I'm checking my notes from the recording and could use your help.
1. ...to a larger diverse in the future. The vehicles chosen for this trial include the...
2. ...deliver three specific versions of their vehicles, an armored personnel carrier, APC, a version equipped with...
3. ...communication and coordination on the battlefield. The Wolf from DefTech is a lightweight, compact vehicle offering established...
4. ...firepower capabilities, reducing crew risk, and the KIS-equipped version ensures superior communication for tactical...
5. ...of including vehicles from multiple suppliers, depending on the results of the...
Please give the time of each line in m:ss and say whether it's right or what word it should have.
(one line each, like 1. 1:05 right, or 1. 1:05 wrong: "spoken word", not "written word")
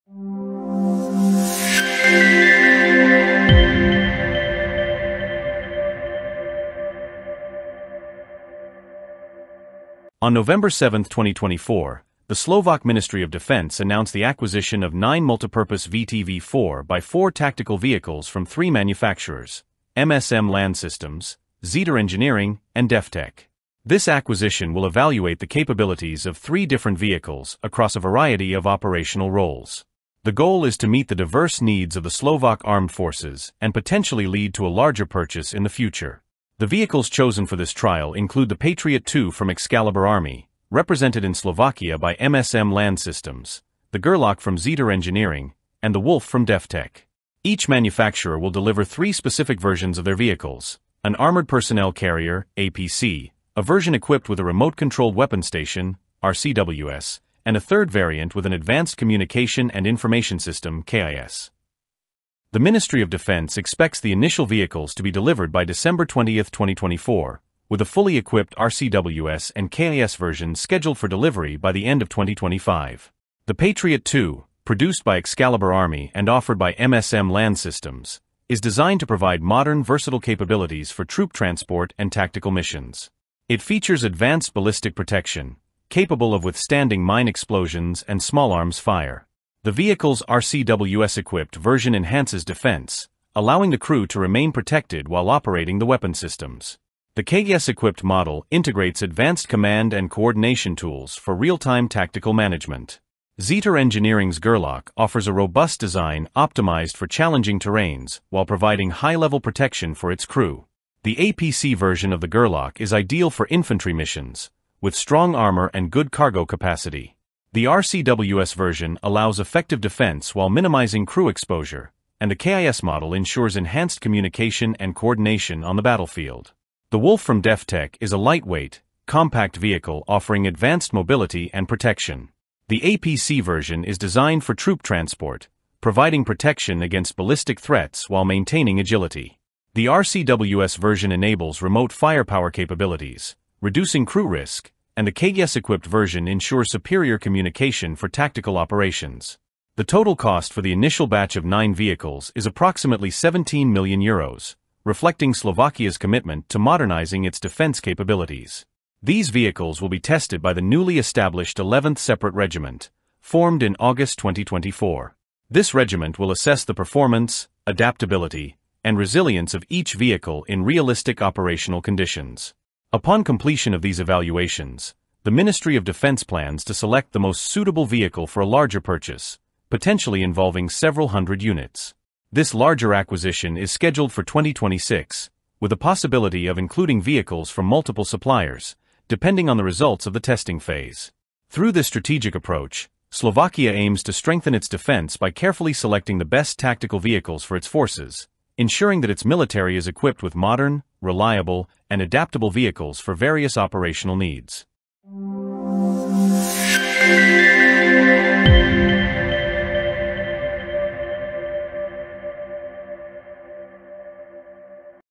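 1. 0:34 wrong: "purchase", not "diverse"
2. 0:48 right
3. 2:03 wrong: "advanced", not "established"
4. 2:21 right
5. 3:06 right.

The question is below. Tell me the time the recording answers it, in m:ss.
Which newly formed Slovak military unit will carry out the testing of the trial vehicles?
2:41.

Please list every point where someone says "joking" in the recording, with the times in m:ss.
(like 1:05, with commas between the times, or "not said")
not said.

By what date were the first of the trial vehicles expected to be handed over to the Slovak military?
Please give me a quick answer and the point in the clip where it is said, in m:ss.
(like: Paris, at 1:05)
December 20, 2024, at 1:05.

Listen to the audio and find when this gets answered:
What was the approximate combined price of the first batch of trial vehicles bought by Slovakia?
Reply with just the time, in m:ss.
2:33.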